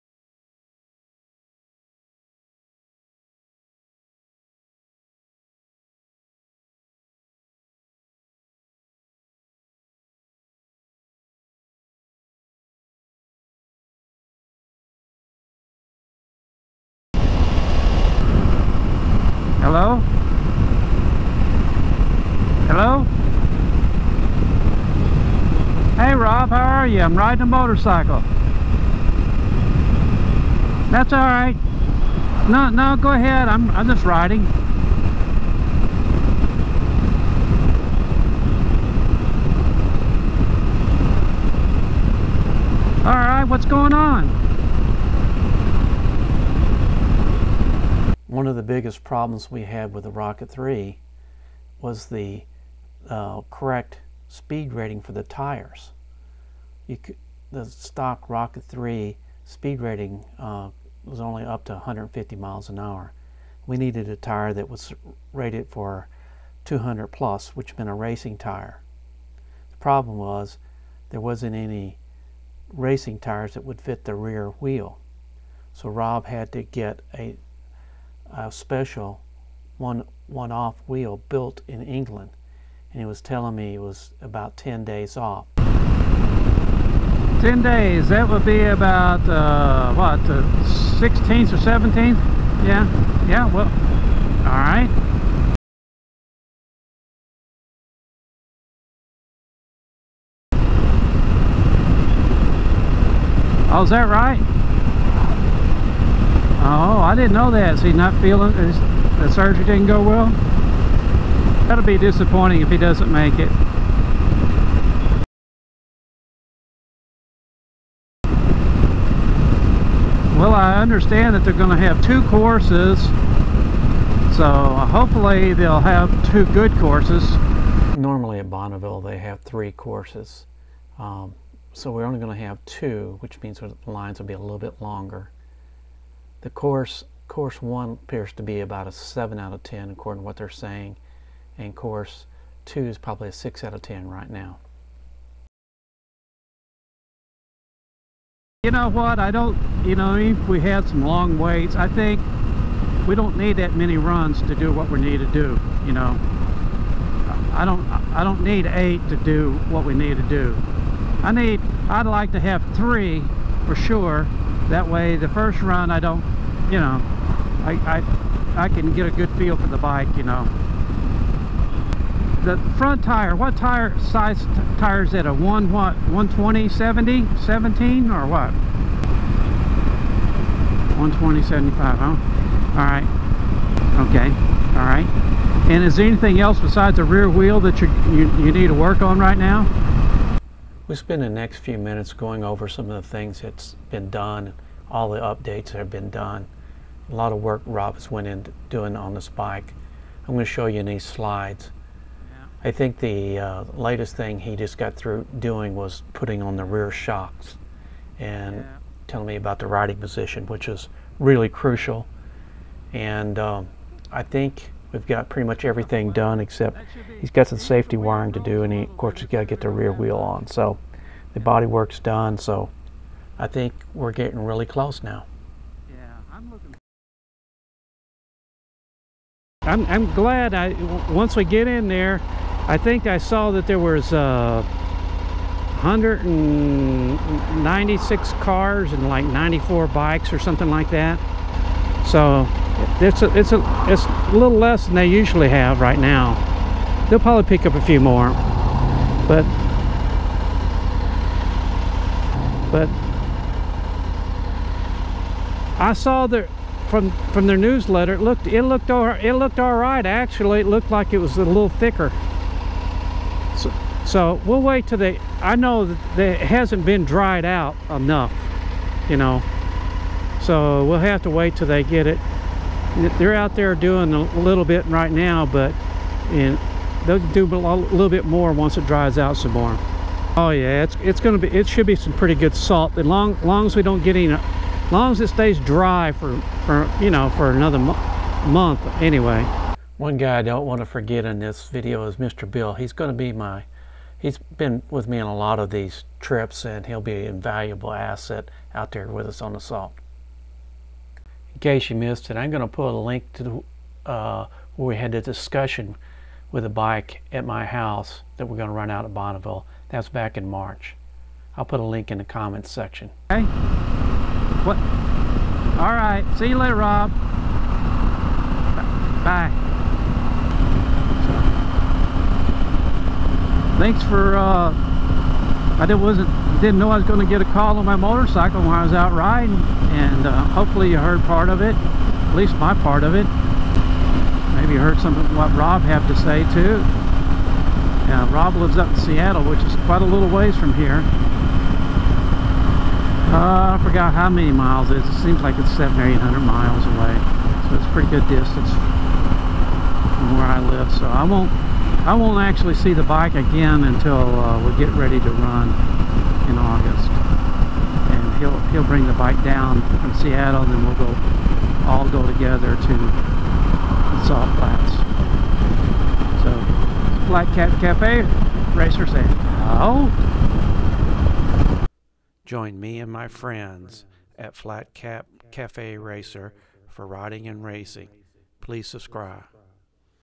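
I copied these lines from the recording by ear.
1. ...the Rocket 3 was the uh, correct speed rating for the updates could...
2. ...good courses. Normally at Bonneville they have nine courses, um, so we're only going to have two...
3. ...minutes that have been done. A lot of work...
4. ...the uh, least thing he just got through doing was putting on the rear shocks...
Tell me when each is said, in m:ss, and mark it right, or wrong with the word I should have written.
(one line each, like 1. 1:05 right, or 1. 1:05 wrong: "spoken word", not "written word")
1. 0:50 wrong: "tires", not "updates"
2. 2:06 wrong: "three", not "nine"
3. 3:15 wrong: "updates", not "minutes"
4. 3:22 wrong: "latest", not "least".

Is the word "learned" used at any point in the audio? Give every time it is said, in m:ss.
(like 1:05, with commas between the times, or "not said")
not said.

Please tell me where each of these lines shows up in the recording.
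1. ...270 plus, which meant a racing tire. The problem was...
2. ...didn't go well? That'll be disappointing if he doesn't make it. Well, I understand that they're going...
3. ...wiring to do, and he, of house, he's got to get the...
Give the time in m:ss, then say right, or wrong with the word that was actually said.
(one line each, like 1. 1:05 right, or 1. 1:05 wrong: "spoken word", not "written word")
1. 1:06 wrong: "200", not "270"
2. 1:49 right
3. 3:37 wrong: "course", not "house".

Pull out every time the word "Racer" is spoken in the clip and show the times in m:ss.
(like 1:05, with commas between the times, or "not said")
6:08, 6:15.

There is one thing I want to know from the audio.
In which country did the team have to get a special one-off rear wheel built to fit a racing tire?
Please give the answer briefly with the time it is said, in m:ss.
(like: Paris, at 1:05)
England, at 1:21.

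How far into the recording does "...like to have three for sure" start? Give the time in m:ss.
2:42.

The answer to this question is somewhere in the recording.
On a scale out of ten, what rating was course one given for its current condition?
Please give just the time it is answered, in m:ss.
2:18.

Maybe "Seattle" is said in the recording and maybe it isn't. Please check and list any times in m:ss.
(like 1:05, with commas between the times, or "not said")
5:38, 6:00.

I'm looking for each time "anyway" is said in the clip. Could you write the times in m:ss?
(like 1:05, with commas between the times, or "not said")
4:49.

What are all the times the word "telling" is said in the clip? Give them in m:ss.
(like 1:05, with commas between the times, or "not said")
1:23, 3:29.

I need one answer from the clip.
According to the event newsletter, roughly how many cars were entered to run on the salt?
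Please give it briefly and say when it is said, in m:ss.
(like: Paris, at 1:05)
196, at 3:55.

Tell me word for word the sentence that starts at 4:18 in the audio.
It looked it looked all, it looked all right actually.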